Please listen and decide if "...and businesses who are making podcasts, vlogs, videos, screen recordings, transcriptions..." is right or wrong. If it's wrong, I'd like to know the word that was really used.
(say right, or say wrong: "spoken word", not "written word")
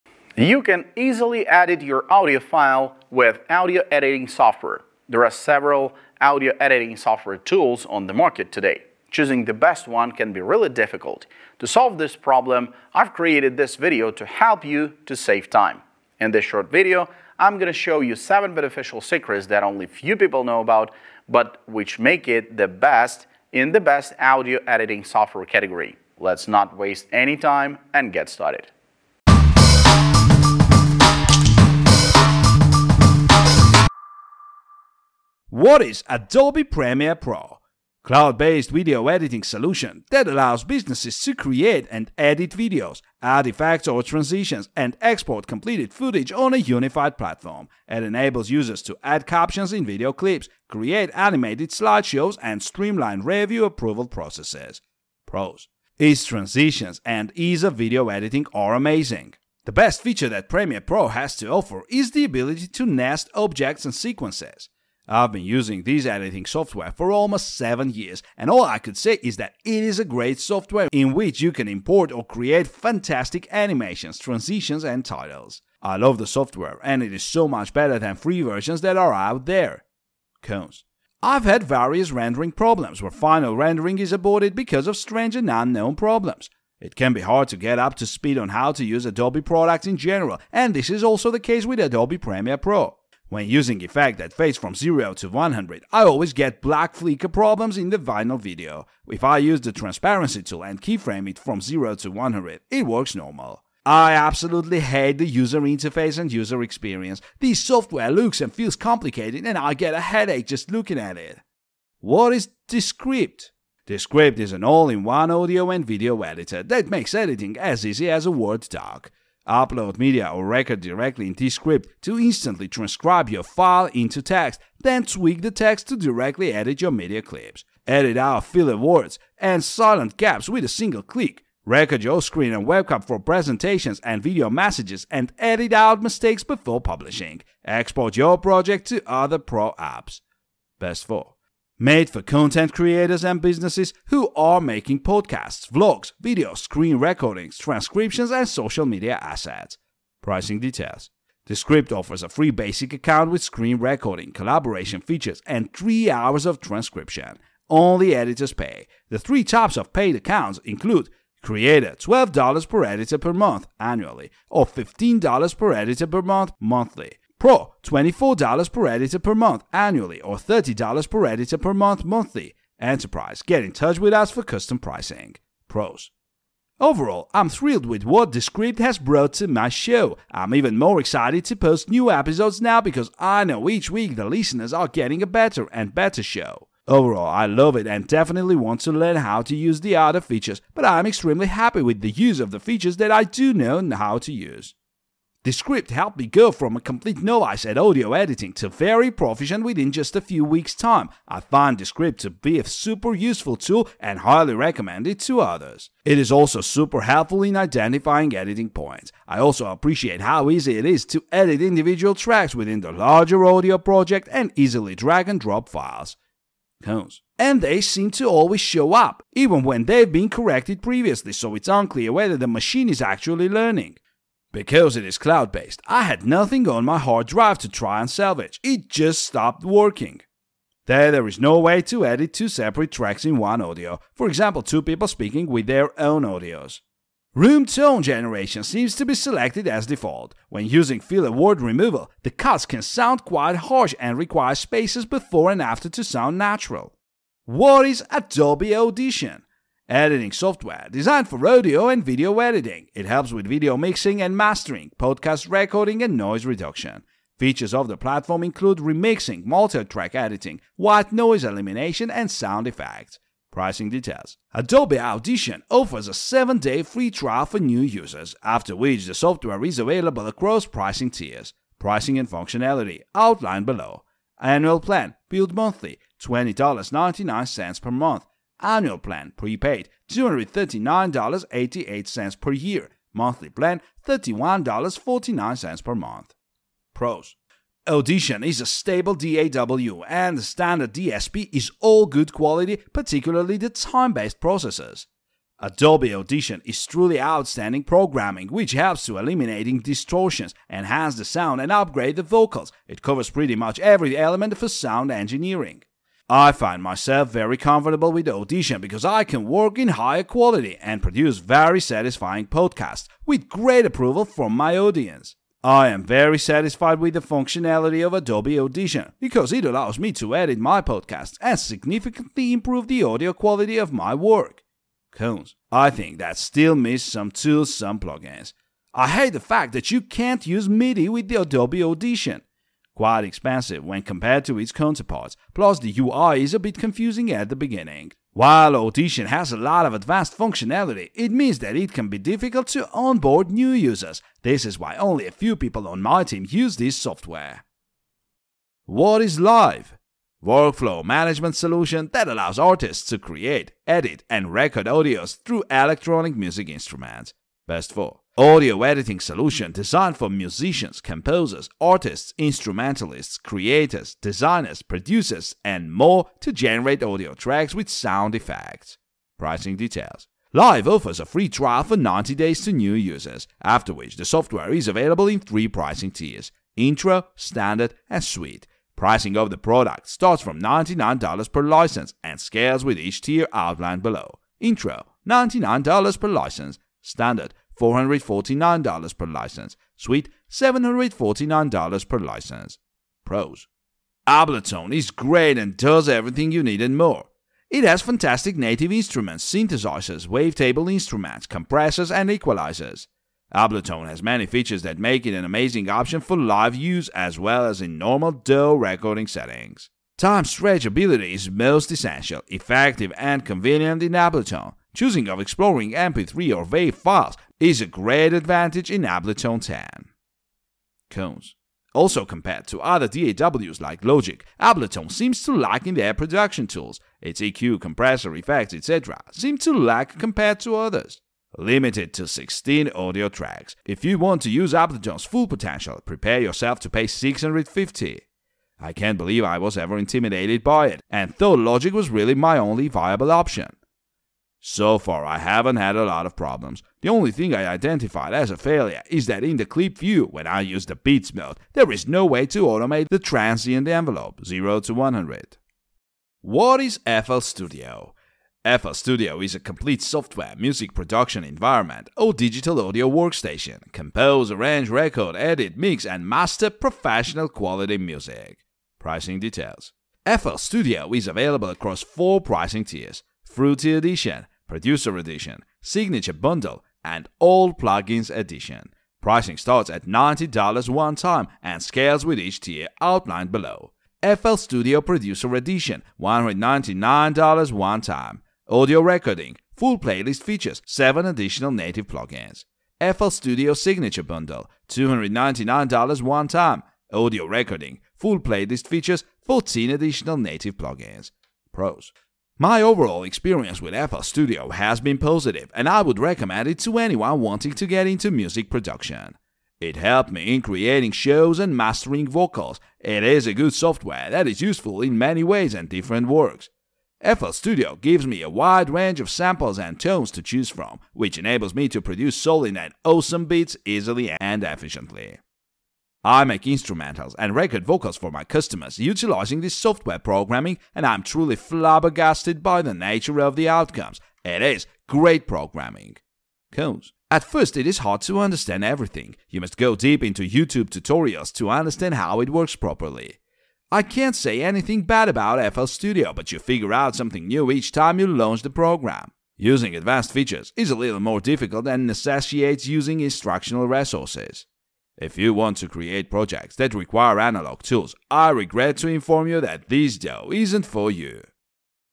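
right.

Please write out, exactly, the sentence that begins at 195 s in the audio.
Descript helped me go from a complete novice at audio editing to very proficient within just a few weeks' time.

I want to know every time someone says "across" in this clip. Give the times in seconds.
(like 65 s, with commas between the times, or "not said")
270 s, 471 s.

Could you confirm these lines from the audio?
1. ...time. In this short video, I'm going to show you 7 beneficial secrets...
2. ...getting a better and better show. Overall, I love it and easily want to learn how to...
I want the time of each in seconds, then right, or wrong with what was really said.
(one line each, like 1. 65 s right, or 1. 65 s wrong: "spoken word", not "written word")
1. 15 s right
2. 184 s wrong: "definitely", not "easily".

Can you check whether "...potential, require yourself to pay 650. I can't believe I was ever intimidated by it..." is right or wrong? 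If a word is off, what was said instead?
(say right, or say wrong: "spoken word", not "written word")
wrong: "prepare", not "require".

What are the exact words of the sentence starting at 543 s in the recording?
I can't say anything bad about FL Studio, but you figure out something new each time you launch the program.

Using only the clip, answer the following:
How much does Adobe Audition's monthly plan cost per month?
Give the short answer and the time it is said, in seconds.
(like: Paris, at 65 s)
$31.49, at 284 s.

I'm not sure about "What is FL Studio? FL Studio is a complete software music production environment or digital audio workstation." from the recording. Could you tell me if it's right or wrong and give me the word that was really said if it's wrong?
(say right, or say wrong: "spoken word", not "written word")
right.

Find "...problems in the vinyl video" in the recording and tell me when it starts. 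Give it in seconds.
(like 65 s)
97 s.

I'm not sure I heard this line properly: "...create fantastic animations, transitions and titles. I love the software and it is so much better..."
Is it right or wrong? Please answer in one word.
right.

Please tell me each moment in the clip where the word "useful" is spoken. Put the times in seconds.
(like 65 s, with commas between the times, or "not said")
203 s, 514 s.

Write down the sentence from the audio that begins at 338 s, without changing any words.
While Audition has a lot of advanced functionality, it means that it can be difficult to onboard new users.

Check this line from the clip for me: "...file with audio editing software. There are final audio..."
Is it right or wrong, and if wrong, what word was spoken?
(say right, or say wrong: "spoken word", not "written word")
wrong: "several", not "final".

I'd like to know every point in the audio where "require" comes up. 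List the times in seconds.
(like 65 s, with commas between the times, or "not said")
244 s, 556 s.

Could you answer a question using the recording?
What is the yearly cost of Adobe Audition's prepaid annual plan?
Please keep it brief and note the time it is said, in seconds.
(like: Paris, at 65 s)
$239.88, at 280 s.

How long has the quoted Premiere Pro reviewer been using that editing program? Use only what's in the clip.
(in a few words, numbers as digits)
almost 7 years.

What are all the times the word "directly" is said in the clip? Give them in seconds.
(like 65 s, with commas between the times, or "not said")
120 s, 125 s.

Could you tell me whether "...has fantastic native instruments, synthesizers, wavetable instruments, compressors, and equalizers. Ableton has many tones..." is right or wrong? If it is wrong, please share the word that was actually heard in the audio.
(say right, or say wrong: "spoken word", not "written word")
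wrong: "features", not "tones".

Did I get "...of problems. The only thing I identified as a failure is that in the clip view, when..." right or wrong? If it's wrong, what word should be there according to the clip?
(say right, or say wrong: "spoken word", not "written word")
right.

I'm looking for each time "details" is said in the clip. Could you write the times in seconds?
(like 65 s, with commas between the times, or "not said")
150 s, 263 s, 369 s, 469 s.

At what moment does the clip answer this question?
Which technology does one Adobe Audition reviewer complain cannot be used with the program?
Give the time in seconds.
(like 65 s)
330 s.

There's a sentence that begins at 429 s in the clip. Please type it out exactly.
seem to lack compared to others.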